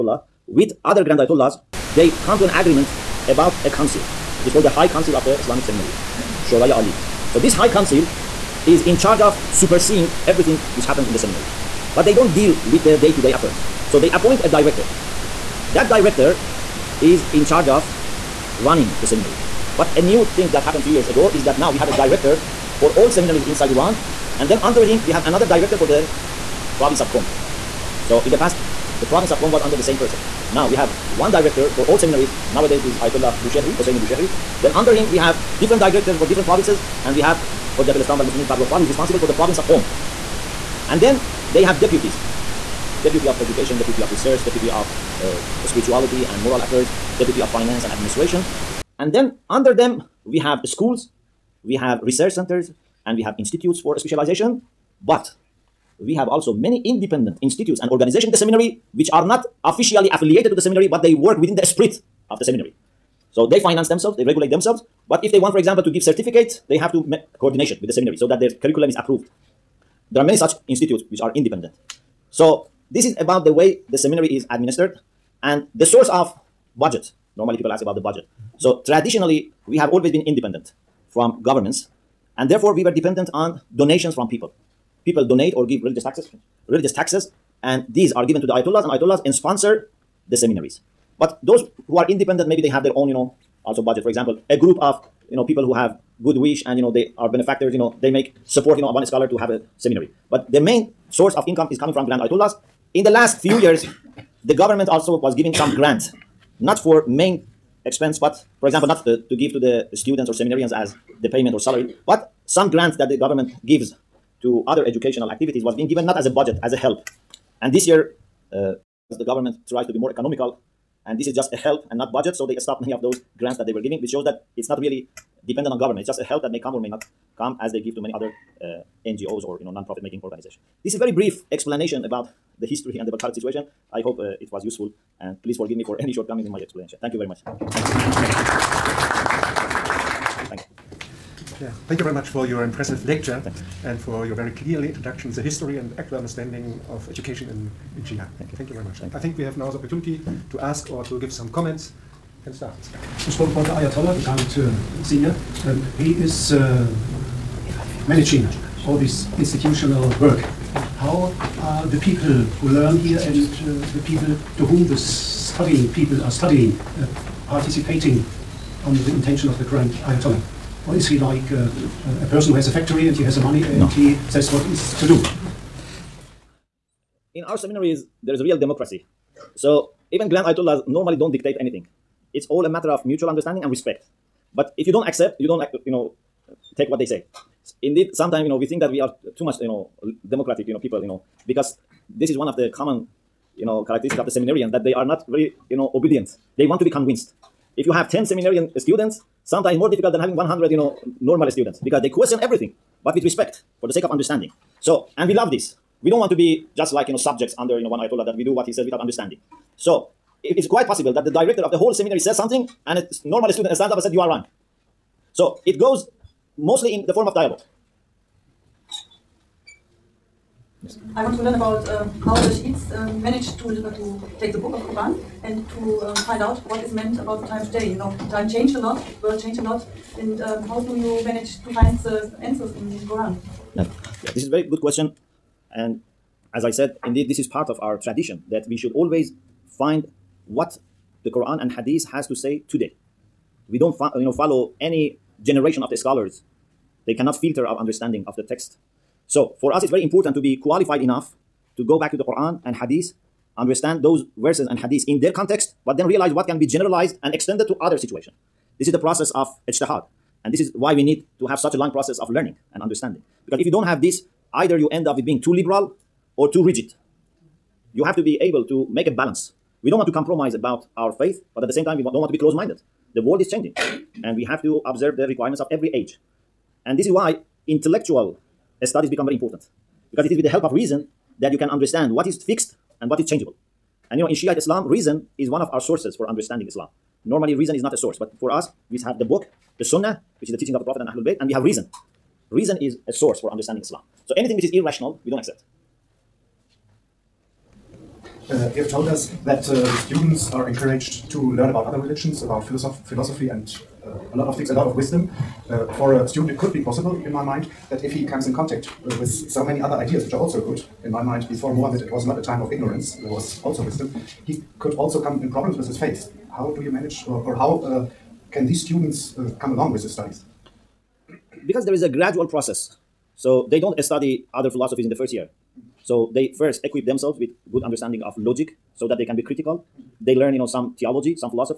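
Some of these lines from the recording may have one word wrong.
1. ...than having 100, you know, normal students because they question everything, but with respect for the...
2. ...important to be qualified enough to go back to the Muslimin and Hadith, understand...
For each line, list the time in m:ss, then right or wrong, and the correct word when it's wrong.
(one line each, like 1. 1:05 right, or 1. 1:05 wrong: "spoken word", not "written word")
1. 3:20 right
2. 4:10 wrong: "Quran", not "Muslimin".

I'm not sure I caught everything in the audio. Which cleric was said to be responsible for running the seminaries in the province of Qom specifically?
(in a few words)
Farrokh Fal.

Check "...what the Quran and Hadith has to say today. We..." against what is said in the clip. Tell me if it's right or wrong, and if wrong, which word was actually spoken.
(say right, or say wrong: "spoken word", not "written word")
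right.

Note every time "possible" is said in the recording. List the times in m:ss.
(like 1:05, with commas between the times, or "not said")
3:30, 5:06.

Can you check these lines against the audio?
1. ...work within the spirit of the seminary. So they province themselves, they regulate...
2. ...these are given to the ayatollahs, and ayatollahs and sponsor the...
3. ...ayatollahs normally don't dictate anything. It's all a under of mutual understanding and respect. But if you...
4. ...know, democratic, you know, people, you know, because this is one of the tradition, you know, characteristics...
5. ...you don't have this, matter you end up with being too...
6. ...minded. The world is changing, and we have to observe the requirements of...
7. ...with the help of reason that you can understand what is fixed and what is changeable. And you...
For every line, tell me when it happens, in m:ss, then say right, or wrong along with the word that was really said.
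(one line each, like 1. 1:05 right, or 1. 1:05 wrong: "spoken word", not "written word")
1. 1:01 wrong: "finance", not "province"
2. 1:27 right
3. 3:00 wrong: "matter", not "under"
4. 3:09 wrong: "common", not "tradition"
5. 4:23 wrong: "either", not "matter"
6. 4:32 right
7. 4:40 right.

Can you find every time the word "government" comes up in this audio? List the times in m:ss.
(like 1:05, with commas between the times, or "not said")
1:21, 1:44, 1:53, 1:59, 2:05.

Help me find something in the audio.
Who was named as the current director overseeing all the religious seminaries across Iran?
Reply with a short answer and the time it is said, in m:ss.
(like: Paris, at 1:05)
Hosseini Bushehri, at 0:33.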